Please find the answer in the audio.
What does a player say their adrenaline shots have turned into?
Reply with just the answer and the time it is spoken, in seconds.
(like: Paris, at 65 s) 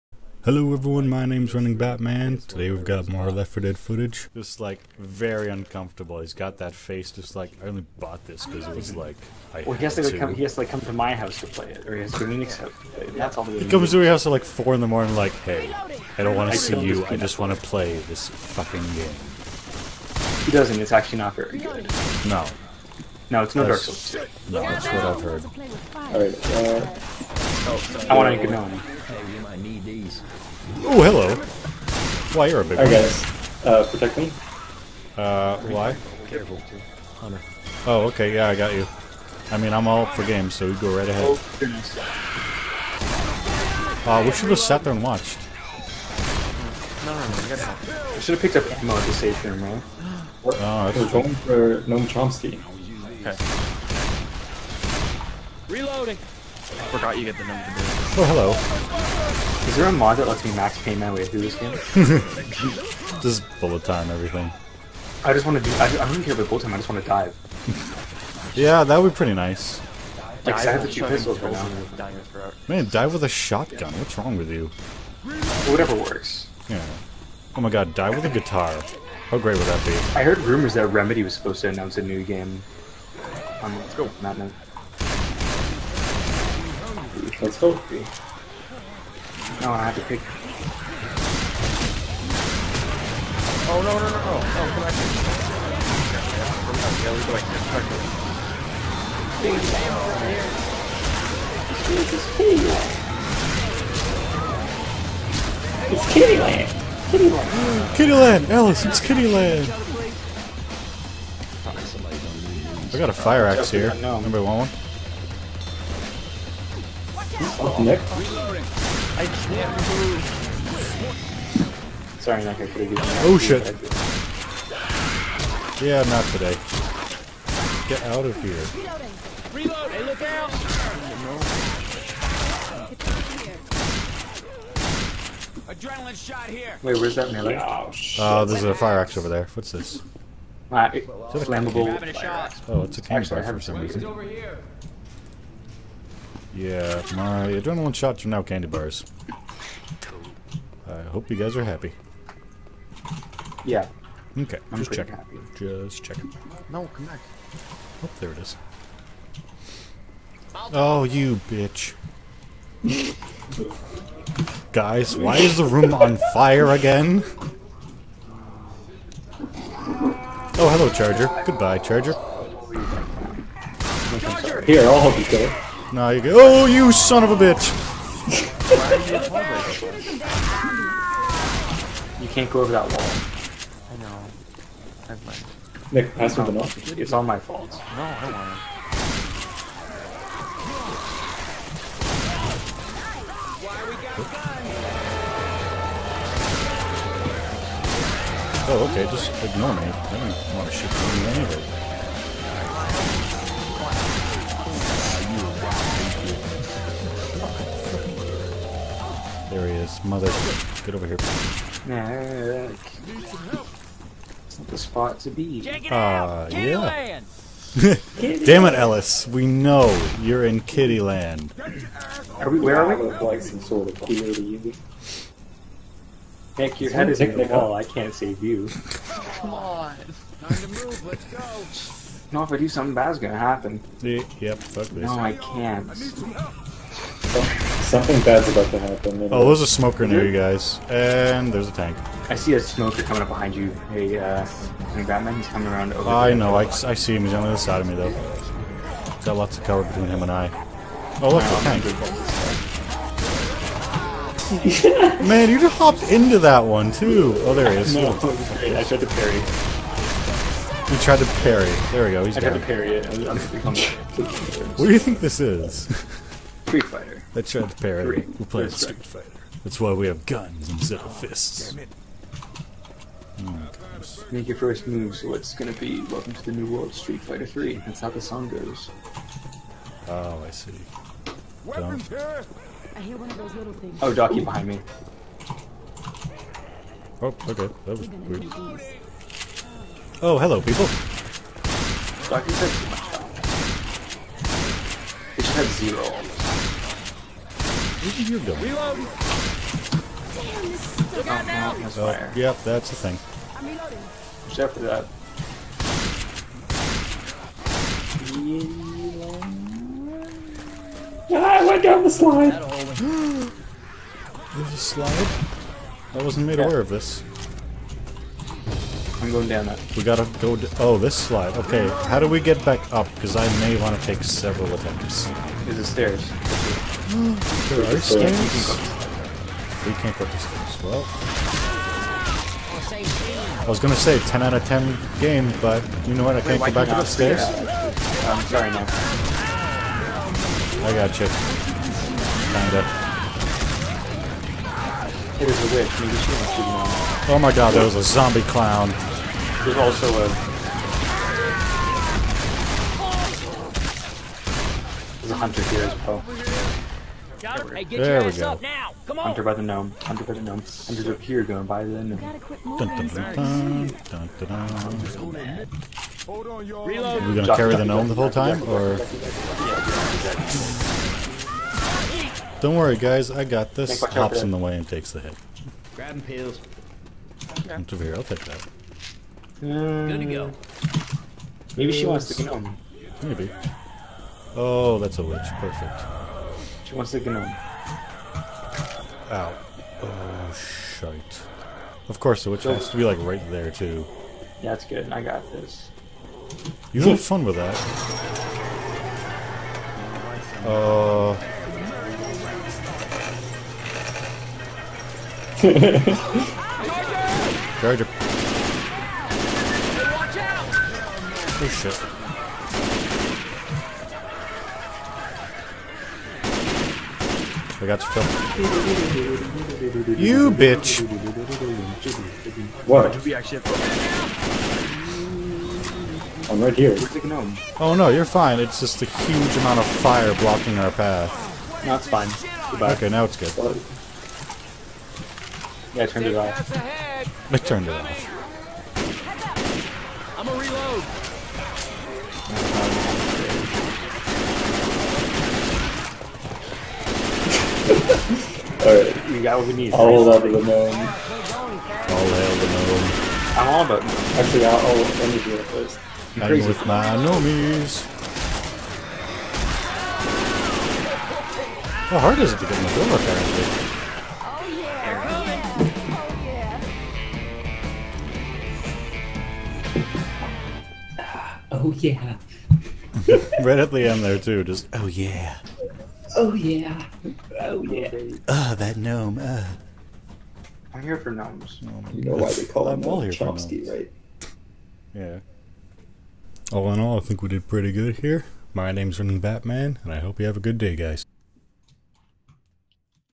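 candy bars, at 148 s.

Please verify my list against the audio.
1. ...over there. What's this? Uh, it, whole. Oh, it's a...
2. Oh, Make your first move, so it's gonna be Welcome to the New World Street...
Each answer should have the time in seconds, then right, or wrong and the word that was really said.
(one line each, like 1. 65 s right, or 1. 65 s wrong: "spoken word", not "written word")
1. 139 s wrong: "flammable", not "whole"
2. 273 s right.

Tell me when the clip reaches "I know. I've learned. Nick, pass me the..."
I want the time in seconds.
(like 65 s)
183 s.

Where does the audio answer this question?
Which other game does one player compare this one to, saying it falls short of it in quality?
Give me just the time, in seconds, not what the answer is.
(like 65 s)
23 s.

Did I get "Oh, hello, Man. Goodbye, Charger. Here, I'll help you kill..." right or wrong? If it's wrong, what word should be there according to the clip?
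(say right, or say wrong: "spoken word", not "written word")
wrong: "Charger", not "Man".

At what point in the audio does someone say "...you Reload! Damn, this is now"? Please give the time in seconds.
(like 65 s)
298 s.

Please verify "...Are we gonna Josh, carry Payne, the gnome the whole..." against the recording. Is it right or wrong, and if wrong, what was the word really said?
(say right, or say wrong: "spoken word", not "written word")
wrong: "Josh", not "Payne".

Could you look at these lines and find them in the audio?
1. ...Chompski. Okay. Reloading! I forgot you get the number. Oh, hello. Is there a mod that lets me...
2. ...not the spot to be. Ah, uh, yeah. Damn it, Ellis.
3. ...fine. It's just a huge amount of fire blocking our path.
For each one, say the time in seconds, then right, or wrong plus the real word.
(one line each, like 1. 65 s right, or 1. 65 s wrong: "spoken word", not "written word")
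1. 52 s right
2. 214 s right
3. 428 s right.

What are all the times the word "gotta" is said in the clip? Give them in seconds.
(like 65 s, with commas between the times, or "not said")
47 s, 320 s.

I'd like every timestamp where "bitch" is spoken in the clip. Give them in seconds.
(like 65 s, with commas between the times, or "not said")
161 s, 177 s, 420 s.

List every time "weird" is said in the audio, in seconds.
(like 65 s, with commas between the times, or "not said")
288 s.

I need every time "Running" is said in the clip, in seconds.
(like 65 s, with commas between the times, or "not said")
1 s, 489 s.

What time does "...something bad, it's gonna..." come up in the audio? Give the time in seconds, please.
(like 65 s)
232 s.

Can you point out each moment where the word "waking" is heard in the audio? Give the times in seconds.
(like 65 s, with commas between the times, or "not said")
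not said.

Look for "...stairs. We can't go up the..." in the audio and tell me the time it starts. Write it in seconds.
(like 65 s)
327 s.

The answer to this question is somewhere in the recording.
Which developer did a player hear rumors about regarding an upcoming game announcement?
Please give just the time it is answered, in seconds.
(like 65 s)
80 s.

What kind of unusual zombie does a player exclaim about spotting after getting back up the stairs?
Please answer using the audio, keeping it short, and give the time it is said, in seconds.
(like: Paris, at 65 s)
zombie clown, at 348 s.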